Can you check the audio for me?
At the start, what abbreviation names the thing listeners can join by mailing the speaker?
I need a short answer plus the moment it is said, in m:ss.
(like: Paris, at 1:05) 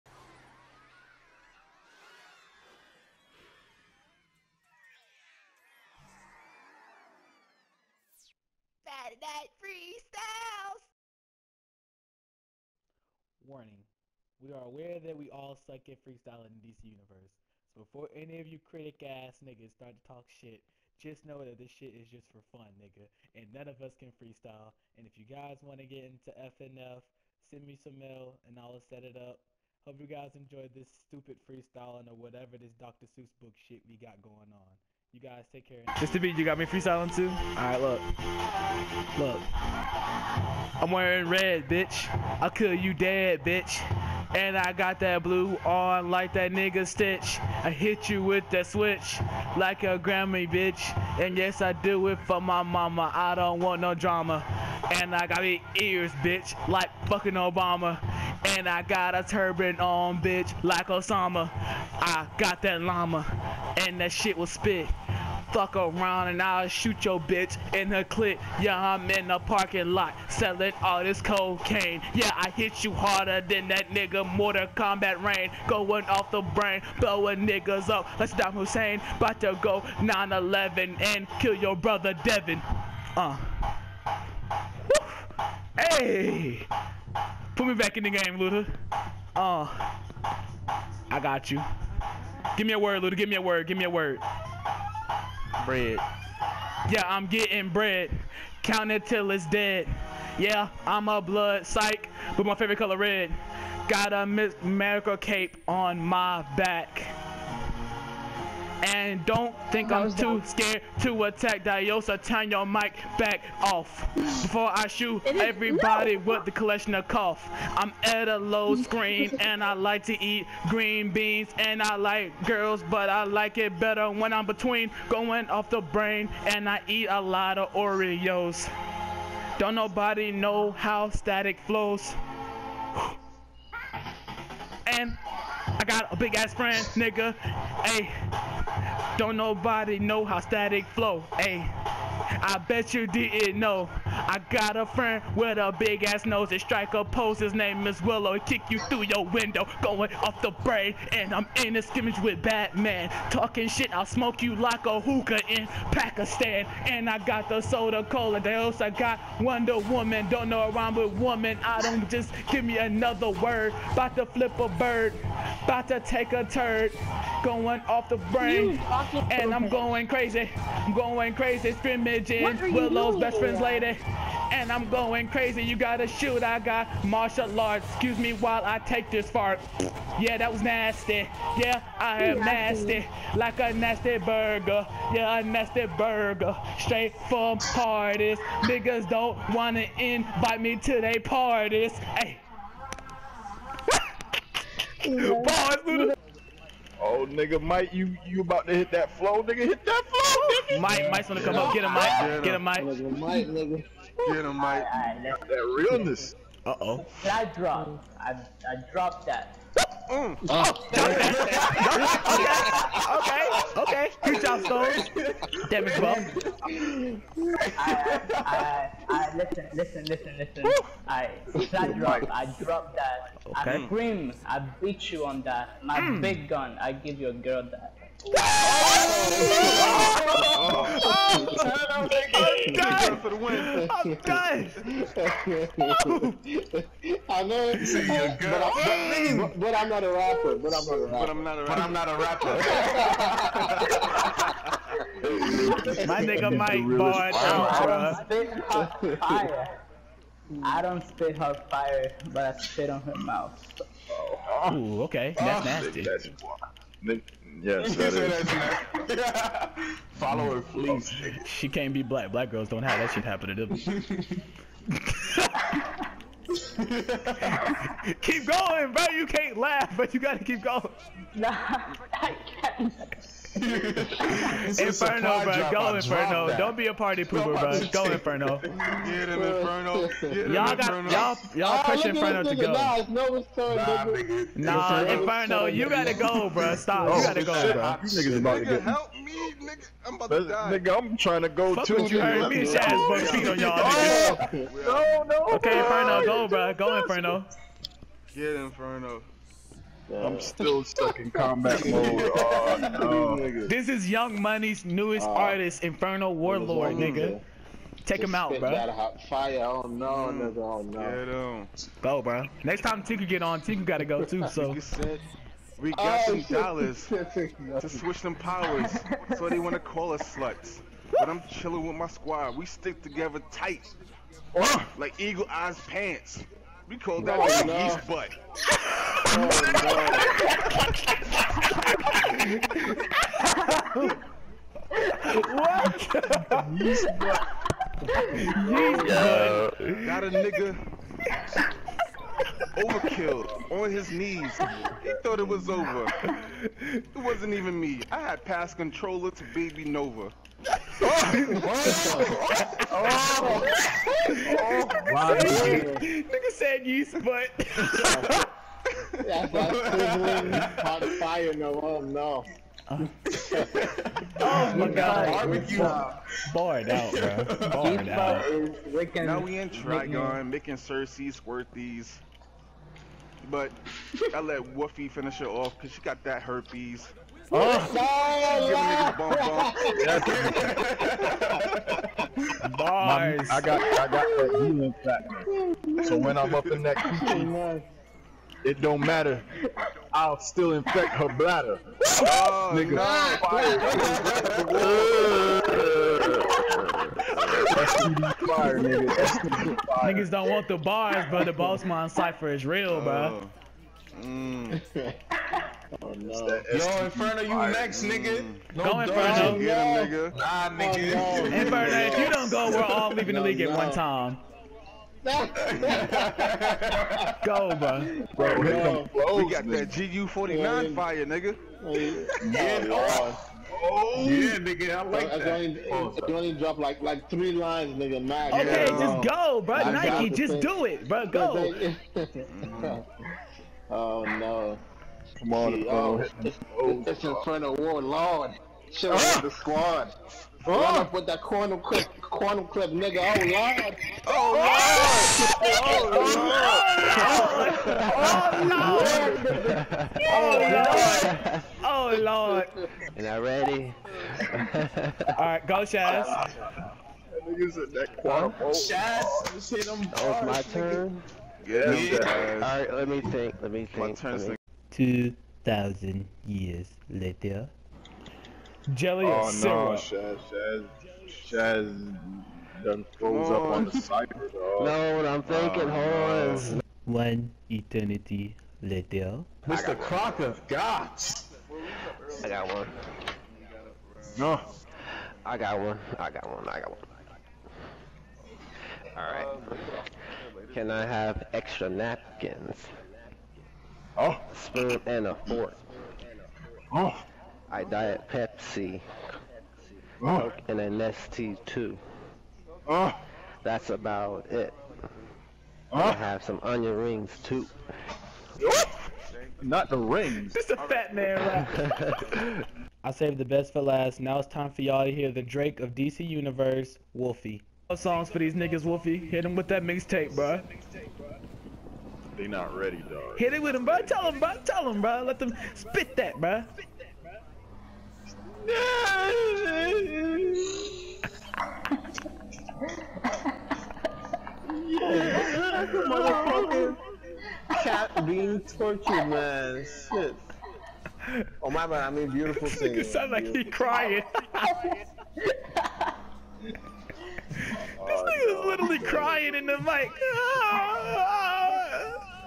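FNF, at 0:26.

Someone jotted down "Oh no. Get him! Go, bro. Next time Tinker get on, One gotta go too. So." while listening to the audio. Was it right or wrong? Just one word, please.
wrong.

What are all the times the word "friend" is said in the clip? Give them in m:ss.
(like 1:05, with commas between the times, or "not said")
2:16, 2:24, 2:53.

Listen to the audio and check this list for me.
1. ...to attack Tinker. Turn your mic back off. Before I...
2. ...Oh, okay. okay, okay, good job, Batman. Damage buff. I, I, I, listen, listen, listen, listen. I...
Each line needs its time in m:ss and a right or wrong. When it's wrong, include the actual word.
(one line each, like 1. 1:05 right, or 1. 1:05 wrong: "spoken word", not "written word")
1. 1:51 wrong: "Diosa", not "Tinker"
2. 3:33 wrong: "Stone", not "Batman".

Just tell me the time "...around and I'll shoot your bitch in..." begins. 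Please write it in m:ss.
1:05.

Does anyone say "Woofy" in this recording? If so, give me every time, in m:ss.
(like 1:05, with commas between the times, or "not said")
6:14.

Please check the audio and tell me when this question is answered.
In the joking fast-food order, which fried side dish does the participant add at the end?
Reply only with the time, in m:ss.
8:26.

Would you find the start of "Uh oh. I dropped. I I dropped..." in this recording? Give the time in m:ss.
3:26.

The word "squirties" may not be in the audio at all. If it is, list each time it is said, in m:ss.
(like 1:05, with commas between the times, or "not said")
6:11.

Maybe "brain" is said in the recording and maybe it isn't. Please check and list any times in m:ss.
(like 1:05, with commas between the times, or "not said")
1:16, 2:05, 2:30, 2:48.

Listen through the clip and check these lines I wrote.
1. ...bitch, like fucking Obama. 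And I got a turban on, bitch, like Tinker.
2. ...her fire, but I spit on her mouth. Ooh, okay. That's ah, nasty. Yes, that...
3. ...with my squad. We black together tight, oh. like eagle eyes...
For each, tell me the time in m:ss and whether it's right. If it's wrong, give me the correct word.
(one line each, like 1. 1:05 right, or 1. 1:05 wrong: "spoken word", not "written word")
1. 0:56 wrong: "Osama", not "Tinker"
2. 4:11 right
3. 5:21 wrong: "stick", not "black".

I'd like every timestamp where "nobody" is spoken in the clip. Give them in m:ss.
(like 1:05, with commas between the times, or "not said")
2:09, 2:19.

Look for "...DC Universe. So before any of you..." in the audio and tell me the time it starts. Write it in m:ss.
0:16.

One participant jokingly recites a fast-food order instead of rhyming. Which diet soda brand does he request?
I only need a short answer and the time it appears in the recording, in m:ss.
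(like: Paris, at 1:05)
Diet Pepsi, at 8:17.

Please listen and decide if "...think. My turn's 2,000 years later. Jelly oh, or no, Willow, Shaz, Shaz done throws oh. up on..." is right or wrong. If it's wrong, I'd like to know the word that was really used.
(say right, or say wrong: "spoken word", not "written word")
wrong: "Shaz", not "Willow".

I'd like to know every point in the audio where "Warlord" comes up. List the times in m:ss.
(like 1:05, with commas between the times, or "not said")
5:06, 7:17.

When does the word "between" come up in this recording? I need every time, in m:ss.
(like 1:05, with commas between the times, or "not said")
2:04.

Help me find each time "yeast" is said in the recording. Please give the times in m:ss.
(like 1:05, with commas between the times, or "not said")
5:36, 5:56.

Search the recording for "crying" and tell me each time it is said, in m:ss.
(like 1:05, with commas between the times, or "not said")
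9:03, 9:08.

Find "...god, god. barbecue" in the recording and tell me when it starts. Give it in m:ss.
6:04.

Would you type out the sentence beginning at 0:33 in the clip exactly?
Seuss book shit we got going on.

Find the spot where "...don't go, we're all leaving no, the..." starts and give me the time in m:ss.
6:52.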